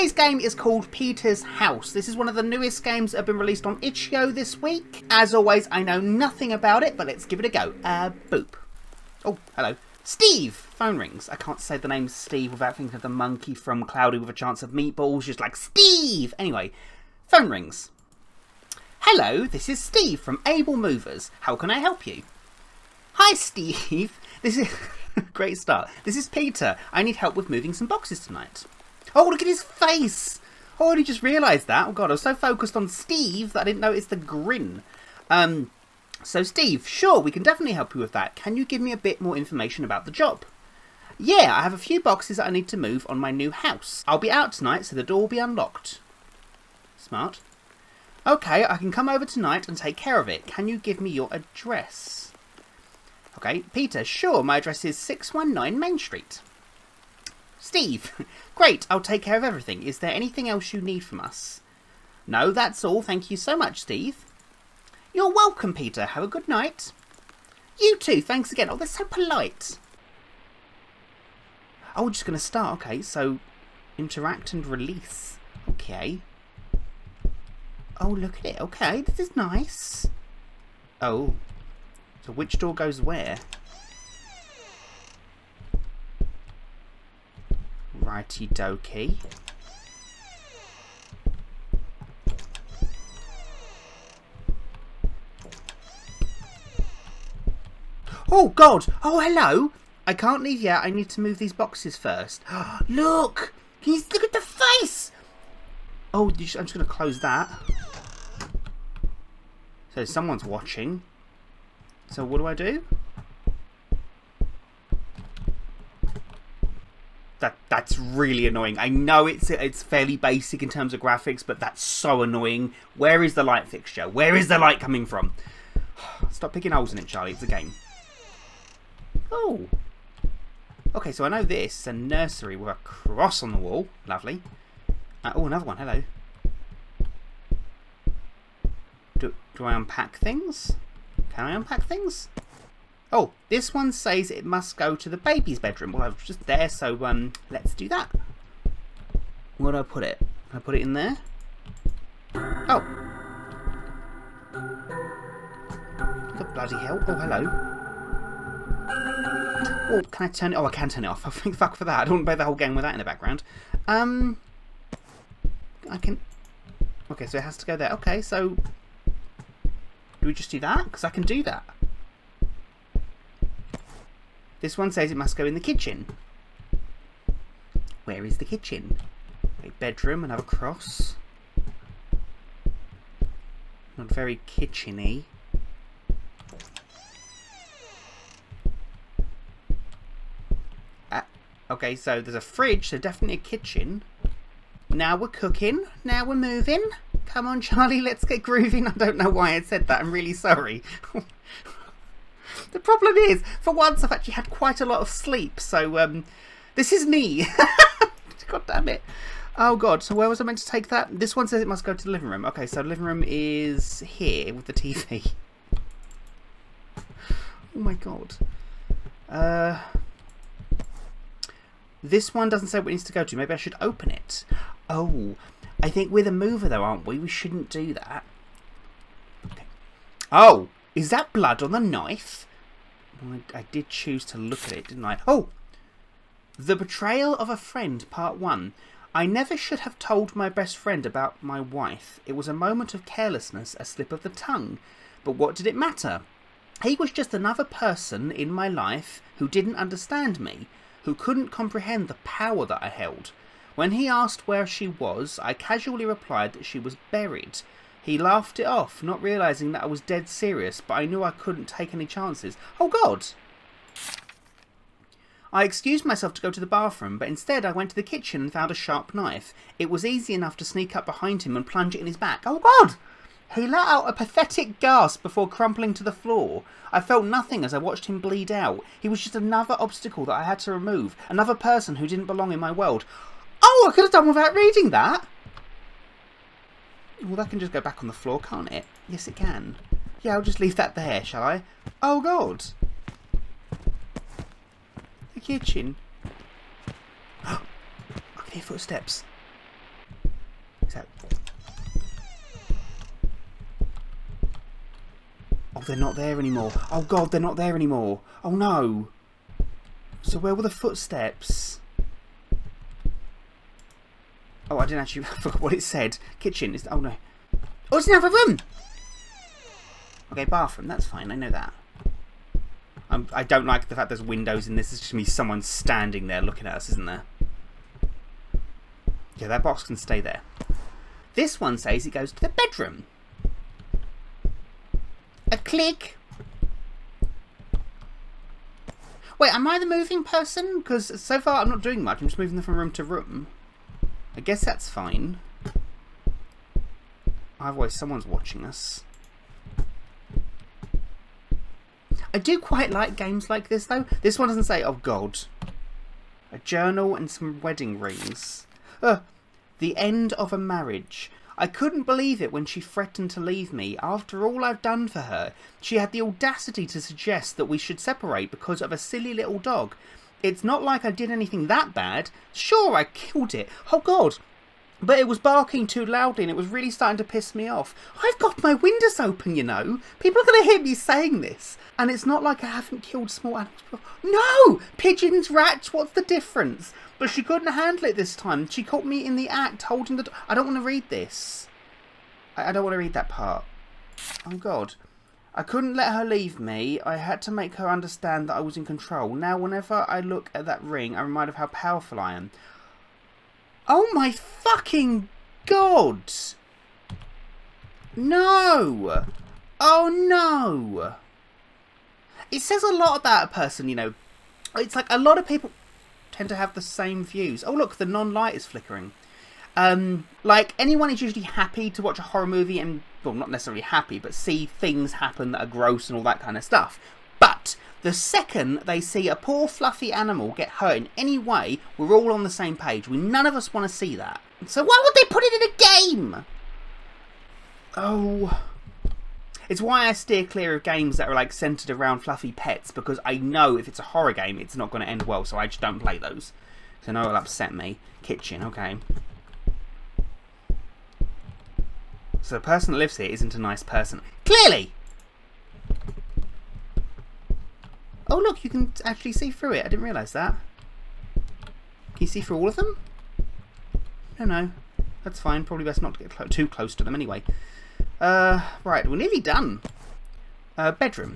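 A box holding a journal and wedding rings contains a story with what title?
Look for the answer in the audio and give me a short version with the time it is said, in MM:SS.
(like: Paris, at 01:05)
The End of a Marriage, at 05:59.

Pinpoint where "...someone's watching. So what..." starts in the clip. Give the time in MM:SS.
01:50.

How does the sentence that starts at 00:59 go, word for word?
Is there anything else you need from us?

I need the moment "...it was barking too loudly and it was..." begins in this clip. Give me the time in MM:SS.
06:15.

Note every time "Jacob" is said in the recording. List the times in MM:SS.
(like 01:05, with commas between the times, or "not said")
not said.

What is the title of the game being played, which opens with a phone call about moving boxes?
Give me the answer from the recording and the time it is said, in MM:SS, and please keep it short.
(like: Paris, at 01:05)
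Peter's House, at 00:00.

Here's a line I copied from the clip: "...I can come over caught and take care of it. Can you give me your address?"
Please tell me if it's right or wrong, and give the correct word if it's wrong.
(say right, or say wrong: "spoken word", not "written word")
wrong: "tonight", not "caught".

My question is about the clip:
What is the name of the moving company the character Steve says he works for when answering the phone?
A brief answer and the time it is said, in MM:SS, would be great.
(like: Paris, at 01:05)
Able Movers, at 00:20.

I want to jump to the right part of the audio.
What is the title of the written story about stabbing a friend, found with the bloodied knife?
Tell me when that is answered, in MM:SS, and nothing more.
03:56.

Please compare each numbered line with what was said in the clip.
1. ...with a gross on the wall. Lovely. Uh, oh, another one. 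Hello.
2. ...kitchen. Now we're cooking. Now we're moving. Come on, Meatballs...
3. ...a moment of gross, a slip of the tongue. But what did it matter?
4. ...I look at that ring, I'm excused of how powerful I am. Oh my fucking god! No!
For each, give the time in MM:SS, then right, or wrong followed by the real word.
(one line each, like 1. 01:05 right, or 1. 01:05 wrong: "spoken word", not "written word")
1. 02:12 wrong: "cross", not "gross"
2. 03:13 wrong: "Charlie", not "Meatballs"
3. 04:02 wrong: "carelessness", not "gross"
4. 06:40 wrong: "reminded", not "excused".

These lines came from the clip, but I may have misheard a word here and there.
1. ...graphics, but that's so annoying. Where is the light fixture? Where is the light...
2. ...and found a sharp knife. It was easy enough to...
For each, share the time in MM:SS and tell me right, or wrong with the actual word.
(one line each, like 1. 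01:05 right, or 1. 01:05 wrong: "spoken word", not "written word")
1. 02:01 right
2. 04:28 right.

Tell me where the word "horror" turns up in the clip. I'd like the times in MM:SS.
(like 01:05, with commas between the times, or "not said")
07:02, 07:24.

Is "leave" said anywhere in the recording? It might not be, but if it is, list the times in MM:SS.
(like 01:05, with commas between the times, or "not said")
01:40, 04:50, 06:03, 06:36.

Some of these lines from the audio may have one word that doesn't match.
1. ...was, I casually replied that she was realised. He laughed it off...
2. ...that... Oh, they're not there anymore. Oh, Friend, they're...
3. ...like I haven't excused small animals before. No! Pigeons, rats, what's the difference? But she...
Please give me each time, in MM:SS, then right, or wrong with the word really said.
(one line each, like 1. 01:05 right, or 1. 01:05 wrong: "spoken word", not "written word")
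1. 04:14 wrong: "buried", not "realised"
2. 05:00 wrong: "God", not "Friend"
3. 06:22 wrong: "killed", not "excused".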